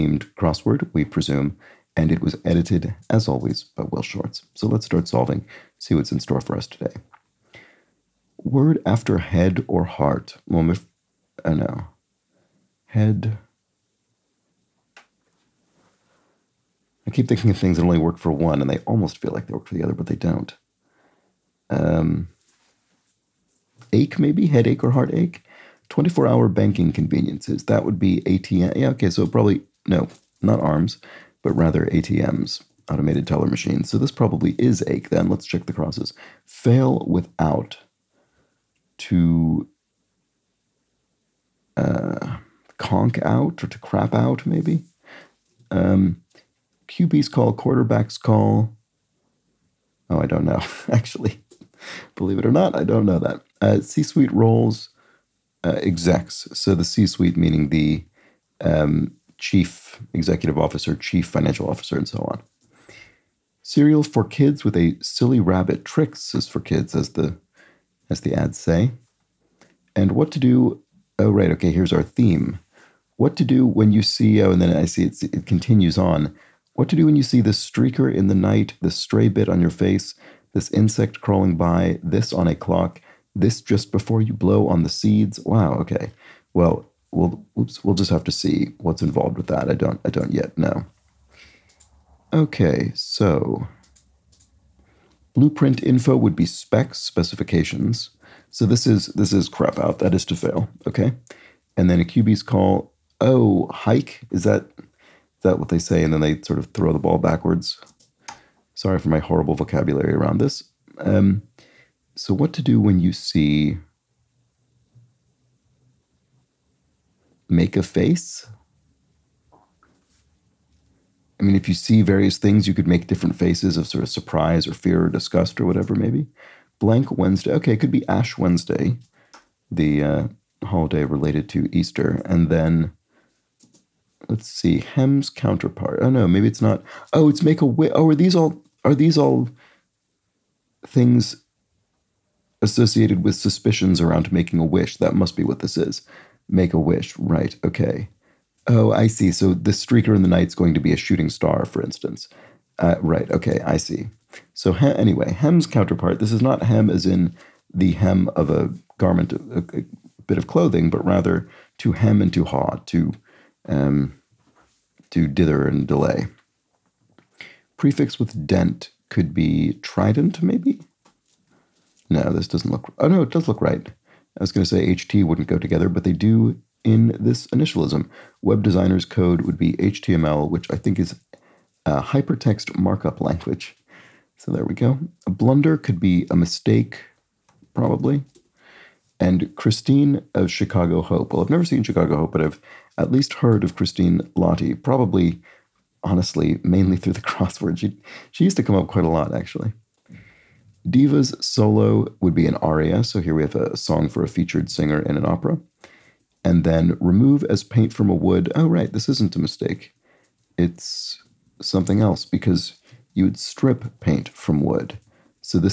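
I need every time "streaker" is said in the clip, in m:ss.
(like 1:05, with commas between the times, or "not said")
1:17, 2:29.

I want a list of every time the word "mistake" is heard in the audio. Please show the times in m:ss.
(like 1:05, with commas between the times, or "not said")
3:06, 3:29.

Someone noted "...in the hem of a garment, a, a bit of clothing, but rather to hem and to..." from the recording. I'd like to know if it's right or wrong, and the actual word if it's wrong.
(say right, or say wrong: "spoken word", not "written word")
right.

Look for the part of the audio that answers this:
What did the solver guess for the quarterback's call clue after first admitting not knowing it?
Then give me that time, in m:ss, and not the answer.
1:43.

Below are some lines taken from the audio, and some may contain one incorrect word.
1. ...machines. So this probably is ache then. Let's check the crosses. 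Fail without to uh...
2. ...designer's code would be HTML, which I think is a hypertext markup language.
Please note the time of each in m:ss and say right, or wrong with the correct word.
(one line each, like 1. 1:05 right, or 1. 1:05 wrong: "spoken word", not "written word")
1. 0:33 right
2. 2:58 right.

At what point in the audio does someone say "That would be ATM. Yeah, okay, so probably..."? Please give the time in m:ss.
0:27.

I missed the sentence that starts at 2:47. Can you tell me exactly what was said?
Prefix with dent could be trident, maybe?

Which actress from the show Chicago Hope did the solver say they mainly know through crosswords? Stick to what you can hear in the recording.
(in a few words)
Christine Lahti.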